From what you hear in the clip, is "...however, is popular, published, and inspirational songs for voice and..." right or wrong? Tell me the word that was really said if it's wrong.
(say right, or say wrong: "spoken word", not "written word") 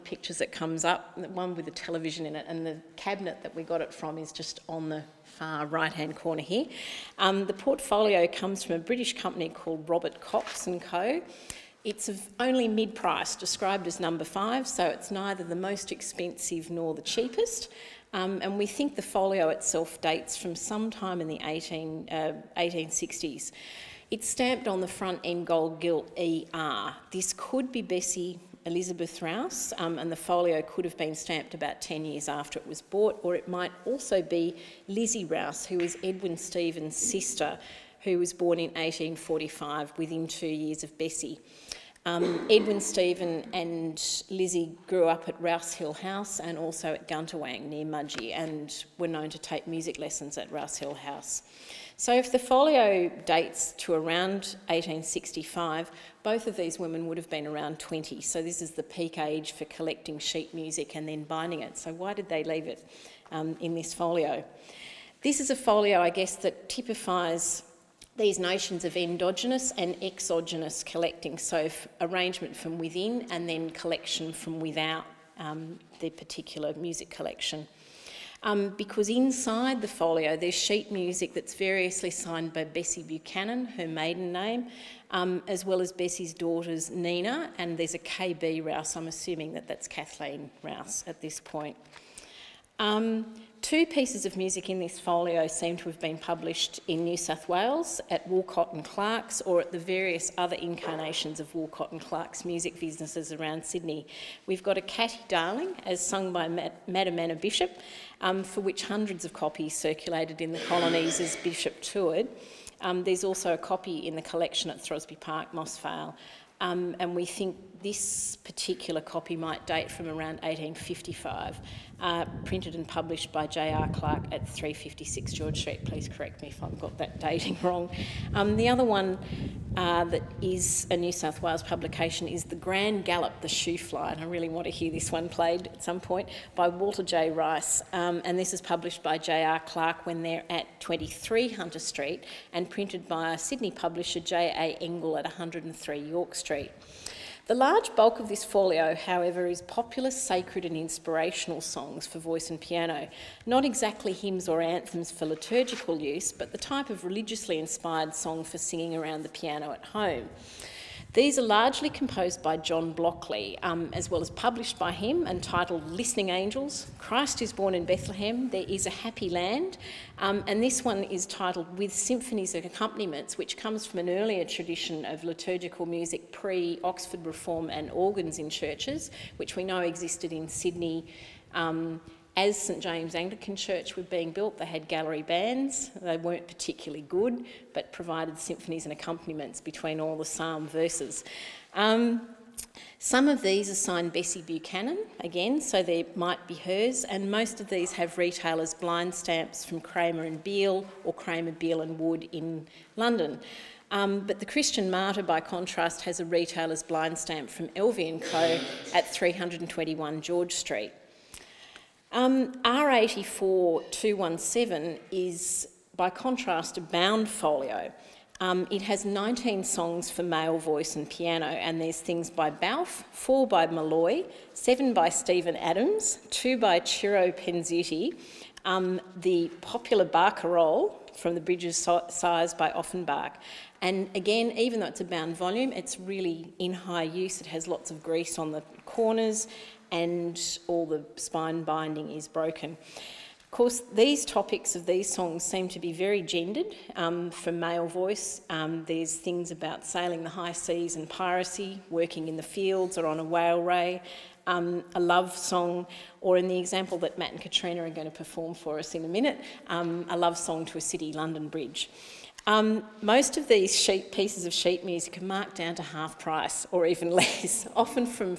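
wrong: "sacred", not "published".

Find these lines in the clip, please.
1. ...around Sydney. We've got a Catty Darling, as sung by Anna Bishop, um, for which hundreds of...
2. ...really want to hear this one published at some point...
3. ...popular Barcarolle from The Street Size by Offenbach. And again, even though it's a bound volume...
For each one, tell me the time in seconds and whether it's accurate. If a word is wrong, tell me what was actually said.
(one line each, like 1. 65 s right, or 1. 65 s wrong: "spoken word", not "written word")
1. 103 s right
2. 134 s wrong: "played", not "published"
3. 229 s wrong: "Bridges", not "Street".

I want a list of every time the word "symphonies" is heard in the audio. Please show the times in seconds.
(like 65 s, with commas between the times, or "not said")
171 s, 188 s.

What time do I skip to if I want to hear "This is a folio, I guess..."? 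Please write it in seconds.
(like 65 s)
65 s.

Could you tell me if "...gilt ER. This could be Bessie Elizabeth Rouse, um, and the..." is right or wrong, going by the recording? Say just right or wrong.
right.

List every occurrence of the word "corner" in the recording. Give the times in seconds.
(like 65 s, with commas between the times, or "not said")
6 s, 238 s.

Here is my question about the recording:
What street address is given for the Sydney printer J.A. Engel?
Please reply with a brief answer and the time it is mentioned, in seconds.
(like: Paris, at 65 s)
103 York Street, at 145 s.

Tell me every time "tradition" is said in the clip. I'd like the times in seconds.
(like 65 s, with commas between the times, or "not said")
174 s.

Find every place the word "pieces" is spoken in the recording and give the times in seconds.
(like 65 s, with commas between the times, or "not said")
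93 s, 264 s.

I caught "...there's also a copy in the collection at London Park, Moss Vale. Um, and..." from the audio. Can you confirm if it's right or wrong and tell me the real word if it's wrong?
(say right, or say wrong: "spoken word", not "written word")
wrong: "Throsby", not "London".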